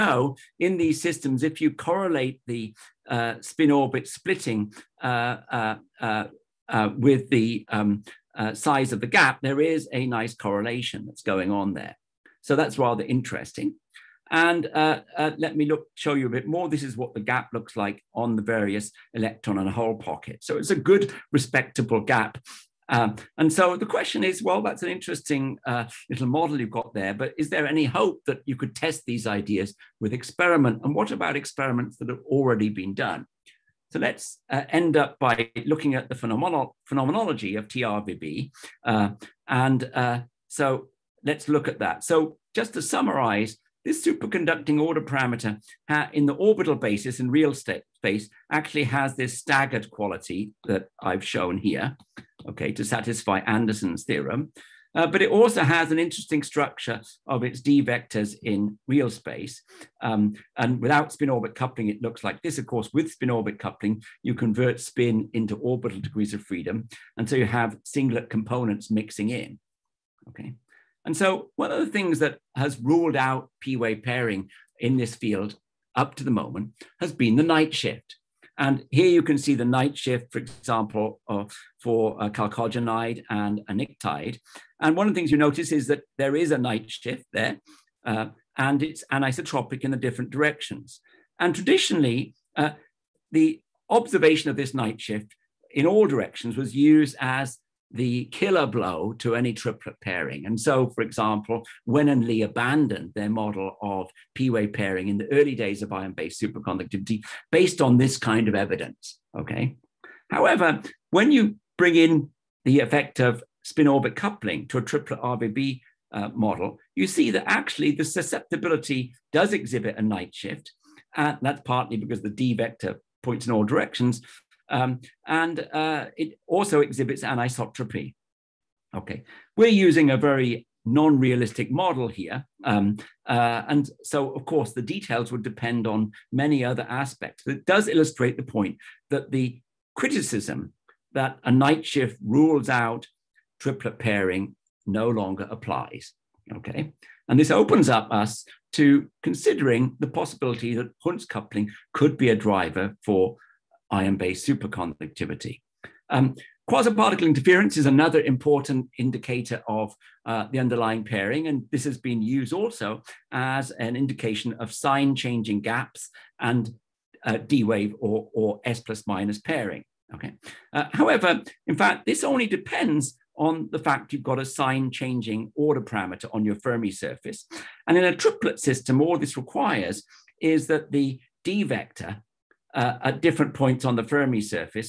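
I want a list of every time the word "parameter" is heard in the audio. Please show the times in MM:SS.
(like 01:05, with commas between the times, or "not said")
00:45, 02:55.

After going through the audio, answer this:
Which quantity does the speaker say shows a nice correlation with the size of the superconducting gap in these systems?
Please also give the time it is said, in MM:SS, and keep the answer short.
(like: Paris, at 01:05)
spin orbit splitting, at 00:03.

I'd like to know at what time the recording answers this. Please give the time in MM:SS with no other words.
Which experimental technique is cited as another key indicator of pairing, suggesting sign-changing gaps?
02:36.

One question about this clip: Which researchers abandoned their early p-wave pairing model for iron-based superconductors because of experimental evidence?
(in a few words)
Wen and Lee.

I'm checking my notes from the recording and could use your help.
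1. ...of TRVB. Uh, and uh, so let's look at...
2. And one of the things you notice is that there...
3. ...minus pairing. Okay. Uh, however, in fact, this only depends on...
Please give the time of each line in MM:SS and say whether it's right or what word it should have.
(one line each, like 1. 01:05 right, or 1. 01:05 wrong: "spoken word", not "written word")
1. 00:37 right
2. 01:24 right
3. 02:49 right.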